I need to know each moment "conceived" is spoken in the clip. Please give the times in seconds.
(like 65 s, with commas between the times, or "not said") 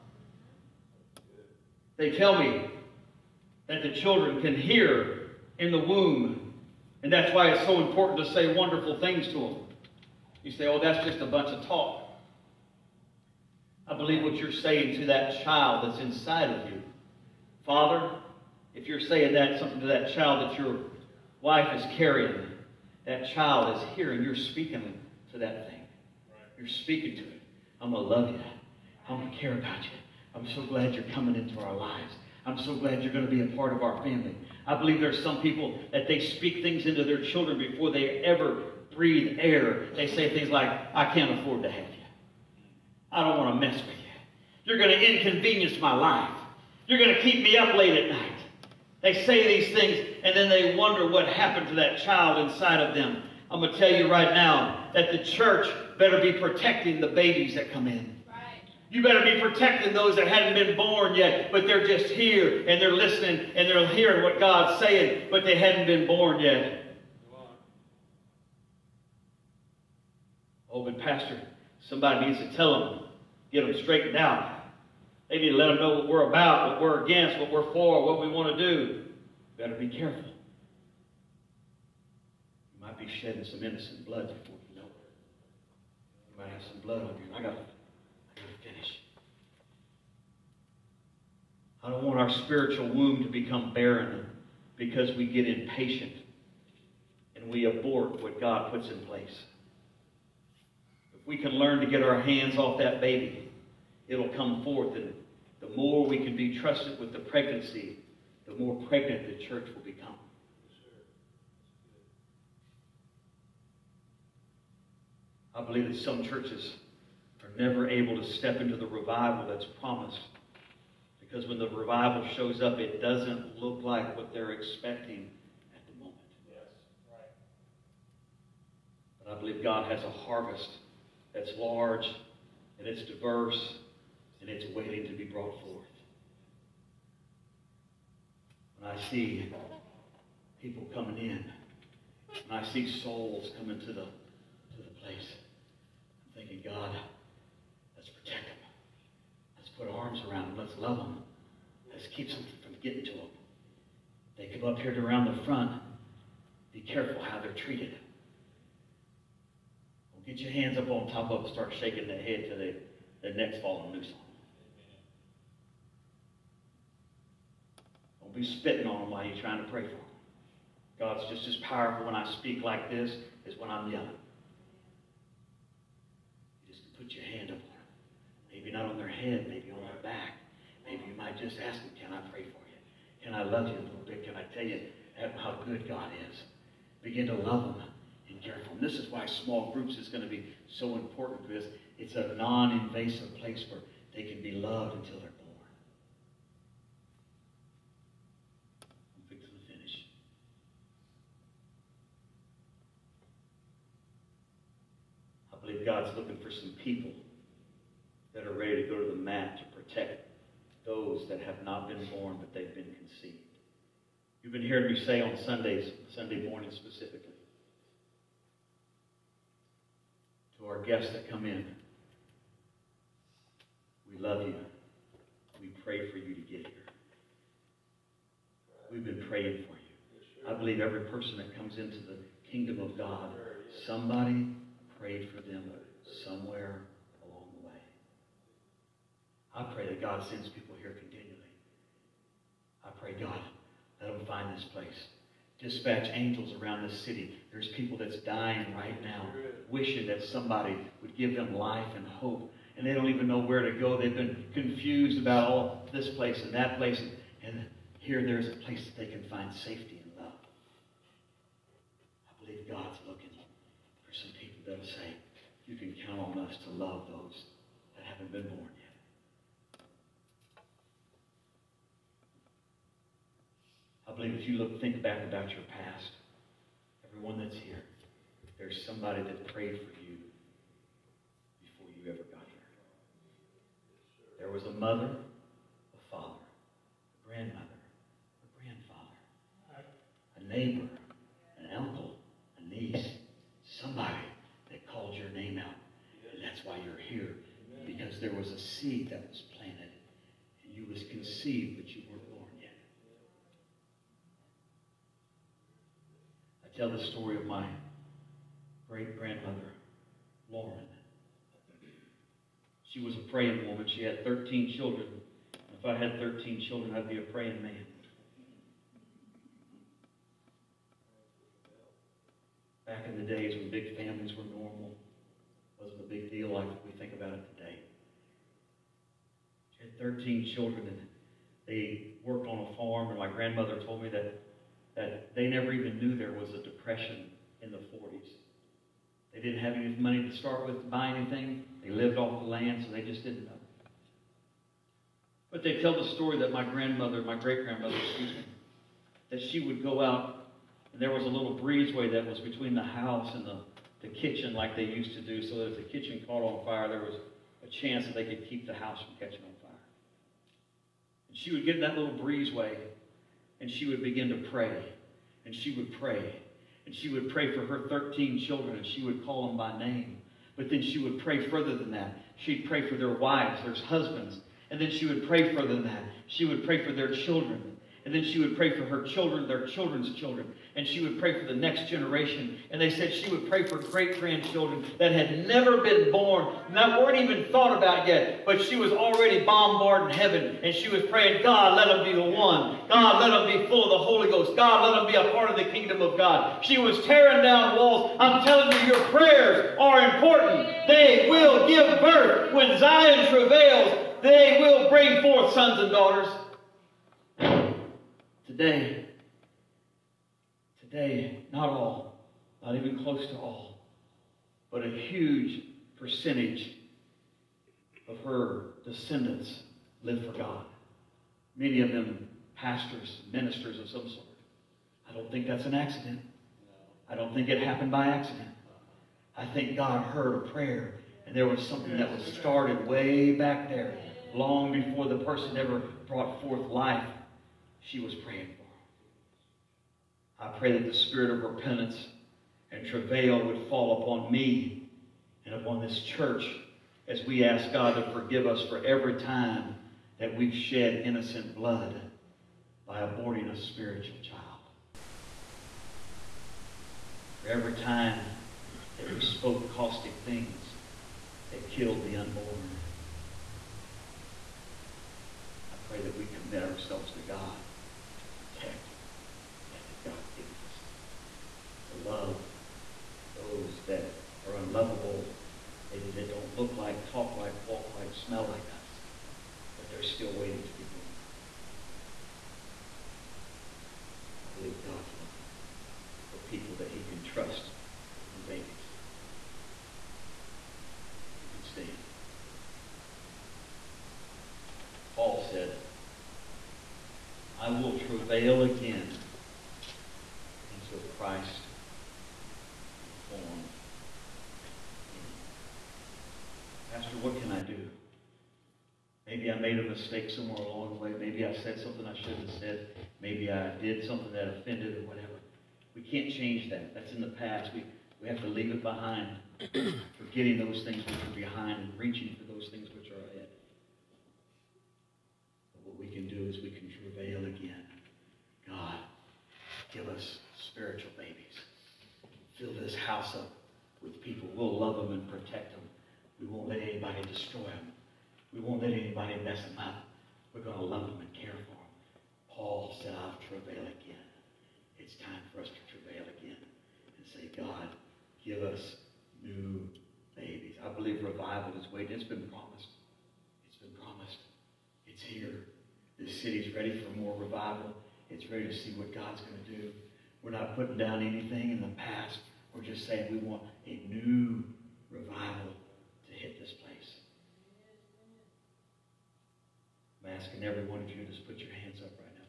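212 s, 301 s.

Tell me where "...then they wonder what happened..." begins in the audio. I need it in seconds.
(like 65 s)
50 s.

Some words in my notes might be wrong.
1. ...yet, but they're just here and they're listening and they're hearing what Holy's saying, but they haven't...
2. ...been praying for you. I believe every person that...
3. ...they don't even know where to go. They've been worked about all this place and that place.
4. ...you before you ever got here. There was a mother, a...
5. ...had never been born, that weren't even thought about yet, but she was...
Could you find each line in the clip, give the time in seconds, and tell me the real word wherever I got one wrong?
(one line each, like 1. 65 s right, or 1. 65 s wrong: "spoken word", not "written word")
1. 61 s wrong: "God", not "Holy"
2. 229 s right
3. 252 s wrong: "confused", not "worked"
4. 280 s right
5. 385 s right.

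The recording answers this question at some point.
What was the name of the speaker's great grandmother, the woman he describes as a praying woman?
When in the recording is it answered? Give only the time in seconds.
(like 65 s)
310 s.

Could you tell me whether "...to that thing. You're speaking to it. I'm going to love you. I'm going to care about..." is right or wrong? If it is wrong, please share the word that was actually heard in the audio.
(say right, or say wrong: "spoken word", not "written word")
right.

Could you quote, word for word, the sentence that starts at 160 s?
Well, get your hands up on top of them.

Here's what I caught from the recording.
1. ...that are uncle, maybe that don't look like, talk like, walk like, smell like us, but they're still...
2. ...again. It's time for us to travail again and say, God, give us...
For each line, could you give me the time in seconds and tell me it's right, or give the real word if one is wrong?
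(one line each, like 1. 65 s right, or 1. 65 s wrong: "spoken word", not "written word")
1. 473 s wrong: "unlovable", not "uncle"
2. 543 s right.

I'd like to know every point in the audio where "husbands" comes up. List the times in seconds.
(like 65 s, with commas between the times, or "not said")
373 s.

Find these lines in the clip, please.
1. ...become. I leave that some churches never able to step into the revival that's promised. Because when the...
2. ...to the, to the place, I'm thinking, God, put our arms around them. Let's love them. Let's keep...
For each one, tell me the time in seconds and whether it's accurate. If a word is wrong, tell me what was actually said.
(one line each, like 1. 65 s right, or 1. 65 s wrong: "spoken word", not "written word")
1. 109 s wrong: "believe", not "leave"
2. 143 s right.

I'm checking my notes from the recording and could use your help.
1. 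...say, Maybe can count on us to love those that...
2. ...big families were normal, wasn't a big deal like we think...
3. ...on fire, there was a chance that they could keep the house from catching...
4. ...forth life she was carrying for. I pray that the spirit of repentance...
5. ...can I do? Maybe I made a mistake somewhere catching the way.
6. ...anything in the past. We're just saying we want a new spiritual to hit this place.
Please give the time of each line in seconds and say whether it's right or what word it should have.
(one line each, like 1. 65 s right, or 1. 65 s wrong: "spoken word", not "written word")
1. 264 s wrong: "You", not "Maybe"
2. 323 s right
3. 356 s right
4. 436 s wrong: "praying", not "carrying"
5. 507 s wrong: "along", not "catching"
6. 561 s wrong: "revival", not "spiritual".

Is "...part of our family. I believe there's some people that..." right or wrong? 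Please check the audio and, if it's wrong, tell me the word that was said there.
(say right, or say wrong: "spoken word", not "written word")
right.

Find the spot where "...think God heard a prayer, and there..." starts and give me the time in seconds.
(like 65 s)
429 s.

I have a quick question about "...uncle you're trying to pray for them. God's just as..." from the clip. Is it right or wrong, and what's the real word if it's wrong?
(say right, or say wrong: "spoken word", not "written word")
wrong: "while", not "uncle".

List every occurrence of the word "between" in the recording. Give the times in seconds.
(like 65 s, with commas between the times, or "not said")
352 s.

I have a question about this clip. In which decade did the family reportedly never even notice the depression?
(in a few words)
the 40s.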